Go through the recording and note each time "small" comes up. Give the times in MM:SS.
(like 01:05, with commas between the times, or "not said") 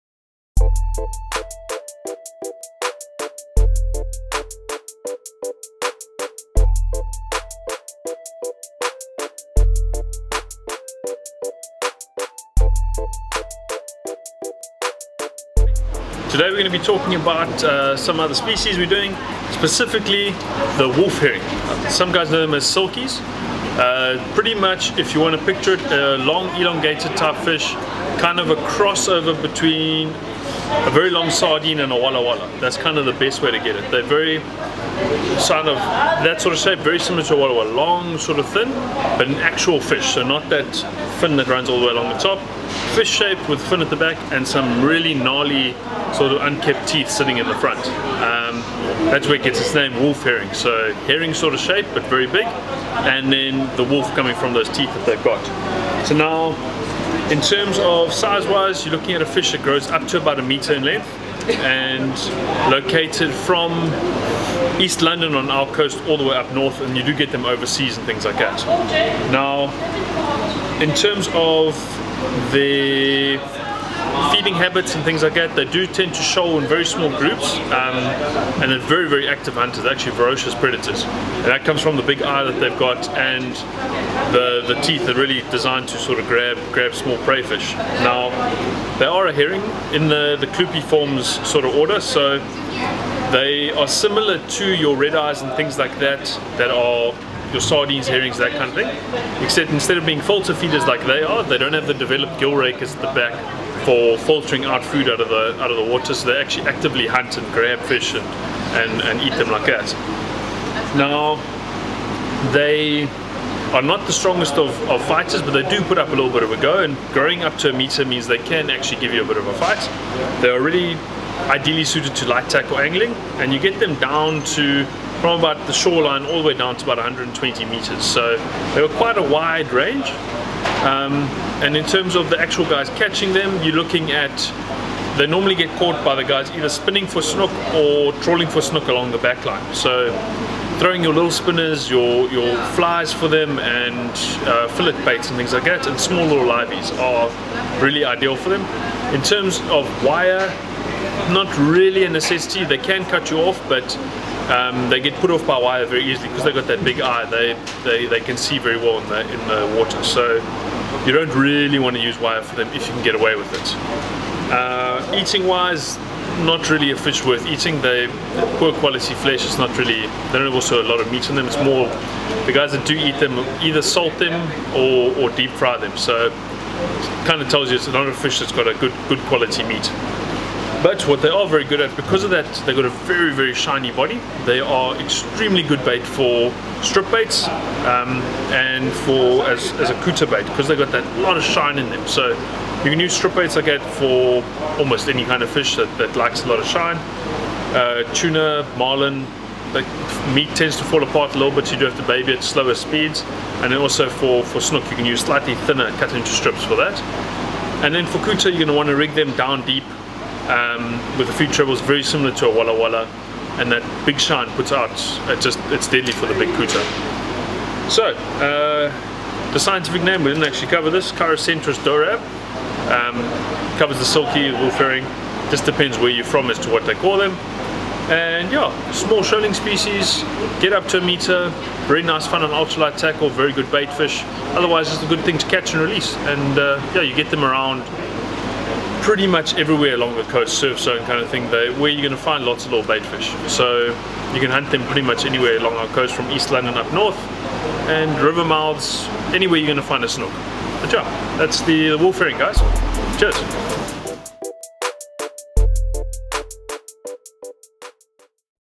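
01:16, 01:26, 02:25, 03:48.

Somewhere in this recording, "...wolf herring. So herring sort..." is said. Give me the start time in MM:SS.
00:50.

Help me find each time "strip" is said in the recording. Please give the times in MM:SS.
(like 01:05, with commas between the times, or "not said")
03:06, 03:13, 03:26.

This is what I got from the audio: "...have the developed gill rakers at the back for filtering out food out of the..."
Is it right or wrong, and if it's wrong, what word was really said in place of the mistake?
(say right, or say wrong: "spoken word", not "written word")
right.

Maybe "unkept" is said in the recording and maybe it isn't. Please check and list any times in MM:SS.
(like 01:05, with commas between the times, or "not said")
00:46.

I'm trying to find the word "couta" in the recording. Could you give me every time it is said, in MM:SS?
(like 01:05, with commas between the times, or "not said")
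03:10, 03:28, 03:36.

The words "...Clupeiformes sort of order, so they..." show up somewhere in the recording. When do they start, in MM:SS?
01:30.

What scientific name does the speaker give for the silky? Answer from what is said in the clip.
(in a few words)
Chirocentrus dorab.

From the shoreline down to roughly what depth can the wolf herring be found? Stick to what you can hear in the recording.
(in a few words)
120 meters.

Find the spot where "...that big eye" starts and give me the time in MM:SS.
02:36.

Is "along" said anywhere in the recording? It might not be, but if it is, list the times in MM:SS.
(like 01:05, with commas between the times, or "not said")
00:41, 02:18, 03:59, 04:05.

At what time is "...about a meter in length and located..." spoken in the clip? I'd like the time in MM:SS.
01:00.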